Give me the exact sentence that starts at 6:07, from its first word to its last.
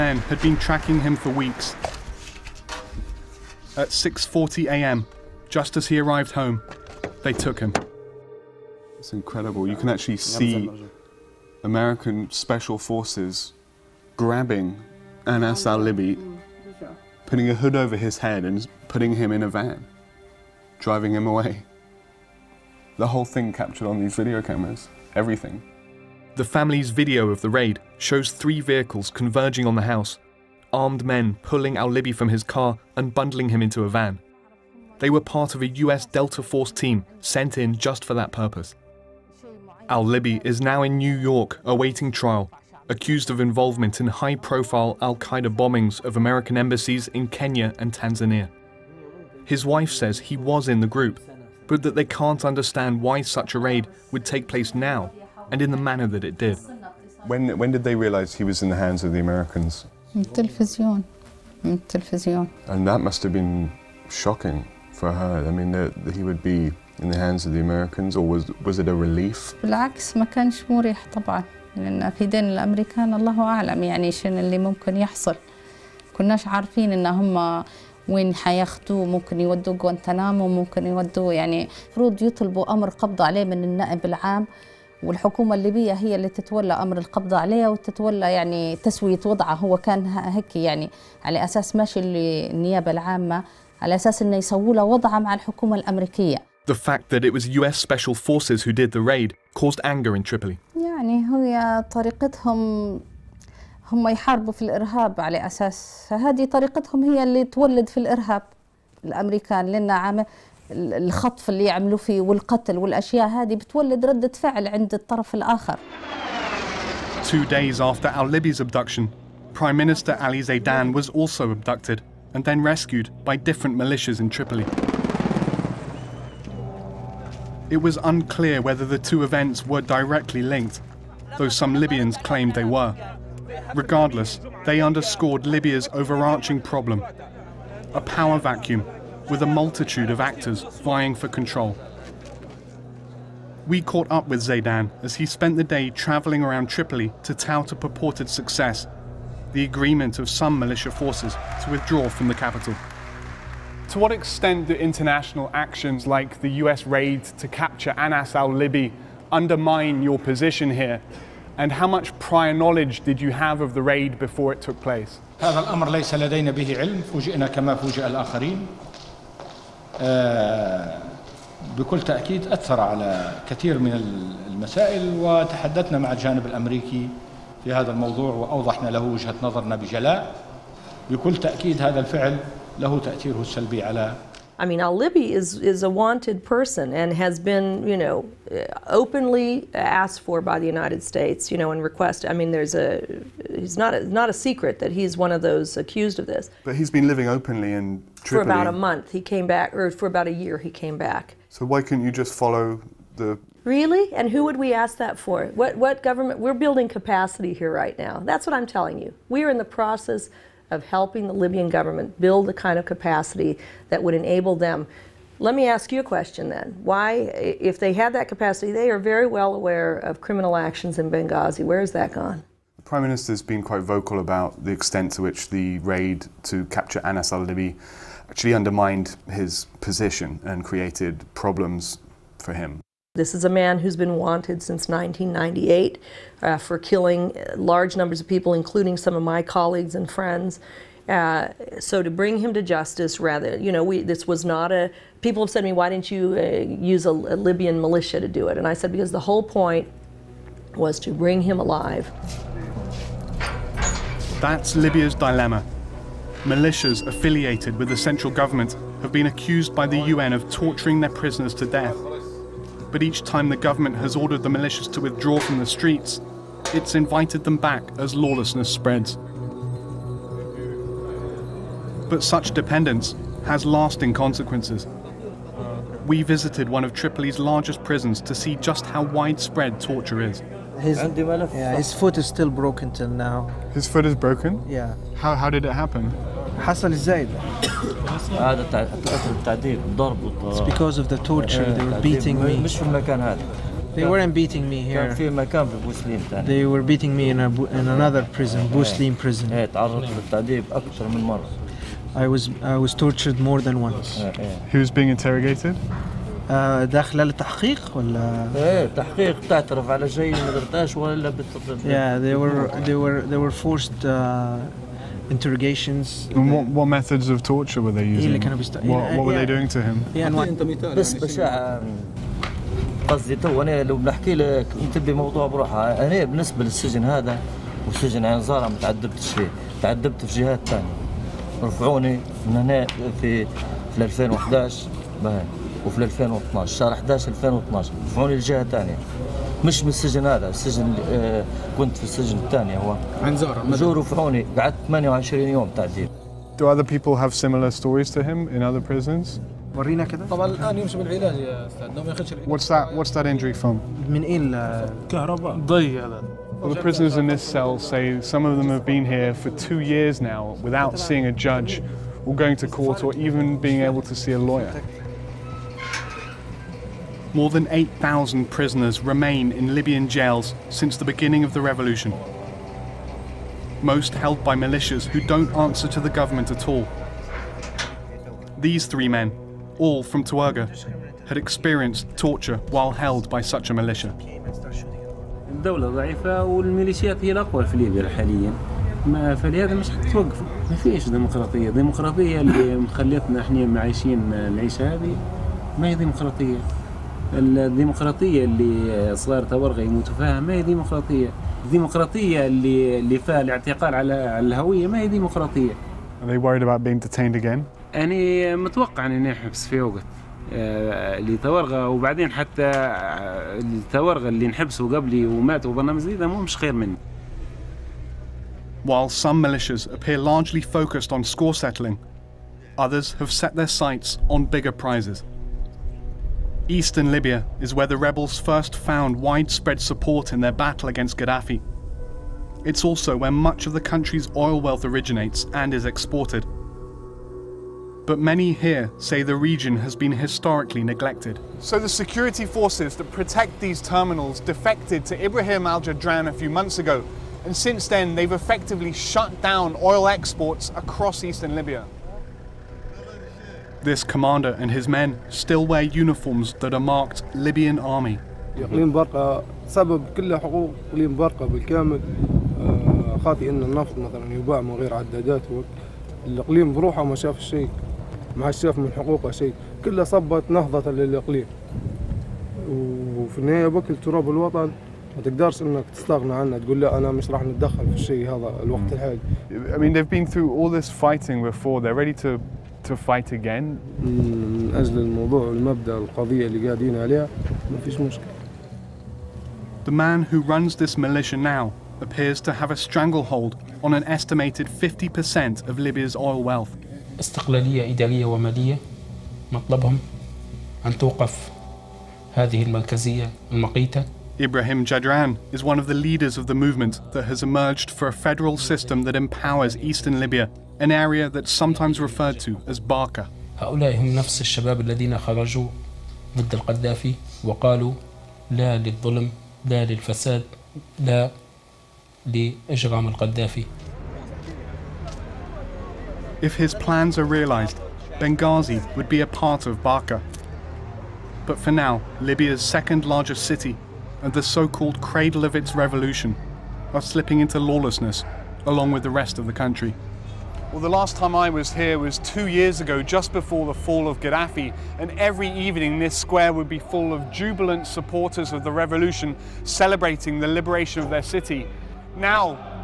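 More than 8,000 prisoners remain in Libyan jails since the beginning of the revolution.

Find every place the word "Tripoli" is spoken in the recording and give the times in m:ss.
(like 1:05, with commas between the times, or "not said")
1:40, 2:04, 2:26, 3:18, 4:36.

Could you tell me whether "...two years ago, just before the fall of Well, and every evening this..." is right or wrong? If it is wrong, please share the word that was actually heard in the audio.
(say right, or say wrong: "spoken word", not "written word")
wrong: "Gaddafi", not "Well".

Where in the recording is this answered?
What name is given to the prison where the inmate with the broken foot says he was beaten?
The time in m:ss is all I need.
4:58.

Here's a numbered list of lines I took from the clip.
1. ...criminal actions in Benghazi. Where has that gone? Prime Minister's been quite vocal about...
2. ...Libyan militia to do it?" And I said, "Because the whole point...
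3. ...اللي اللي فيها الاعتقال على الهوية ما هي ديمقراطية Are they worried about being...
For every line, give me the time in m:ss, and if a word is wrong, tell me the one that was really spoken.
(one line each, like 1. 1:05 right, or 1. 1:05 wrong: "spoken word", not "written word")
1. 3:40 right
2. 4:07 right
3. 6:42 right.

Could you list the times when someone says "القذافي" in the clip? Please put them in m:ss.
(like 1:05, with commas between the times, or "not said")
8:36, 8:42.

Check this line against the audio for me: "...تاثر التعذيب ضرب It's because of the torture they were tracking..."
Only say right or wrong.
wrong.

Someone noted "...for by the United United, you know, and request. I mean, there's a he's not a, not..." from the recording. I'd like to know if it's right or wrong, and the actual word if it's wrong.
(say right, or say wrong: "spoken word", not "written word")
wrong: "States", not "United".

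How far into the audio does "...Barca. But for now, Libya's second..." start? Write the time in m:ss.
8:49.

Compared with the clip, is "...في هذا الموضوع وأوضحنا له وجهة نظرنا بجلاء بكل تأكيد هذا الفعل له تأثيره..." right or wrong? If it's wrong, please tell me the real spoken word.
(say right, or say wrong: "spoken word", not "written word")
right.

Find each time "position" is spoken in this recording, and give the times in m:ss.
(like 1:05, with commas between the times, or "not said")
2:40, 3:49.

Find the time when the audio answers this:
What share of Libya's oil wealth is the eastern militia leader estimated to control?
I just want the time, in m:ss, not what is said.
8:14.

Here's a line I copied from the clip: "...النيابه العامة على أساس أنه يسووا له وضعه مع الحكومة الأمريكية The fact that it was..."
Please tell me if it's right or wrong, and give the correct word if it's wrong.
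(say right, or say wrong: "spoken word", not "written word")
right.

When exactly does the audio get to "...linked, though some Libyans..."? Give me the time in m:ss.
2:10.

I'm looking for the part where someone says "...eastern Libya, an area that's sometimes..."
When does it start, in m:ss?
8:29.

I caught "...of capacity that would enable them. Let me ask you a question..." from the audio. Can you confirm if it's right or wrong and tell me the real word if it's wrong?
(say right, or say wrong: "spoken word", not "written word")
right.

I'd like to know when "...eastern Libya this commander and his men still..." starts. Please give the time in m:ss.
7:31.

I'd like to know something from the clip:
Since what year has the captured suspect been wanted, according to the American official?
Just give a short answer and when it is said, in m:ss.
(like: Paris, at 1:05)
1998, at 3:54.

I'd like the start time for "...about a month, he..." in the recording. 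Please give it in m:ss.
3:18.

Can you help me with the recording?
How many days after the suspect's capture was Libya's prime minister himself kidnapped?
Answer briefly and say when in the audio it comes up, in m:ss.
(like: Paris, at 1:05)
2, at 1:57.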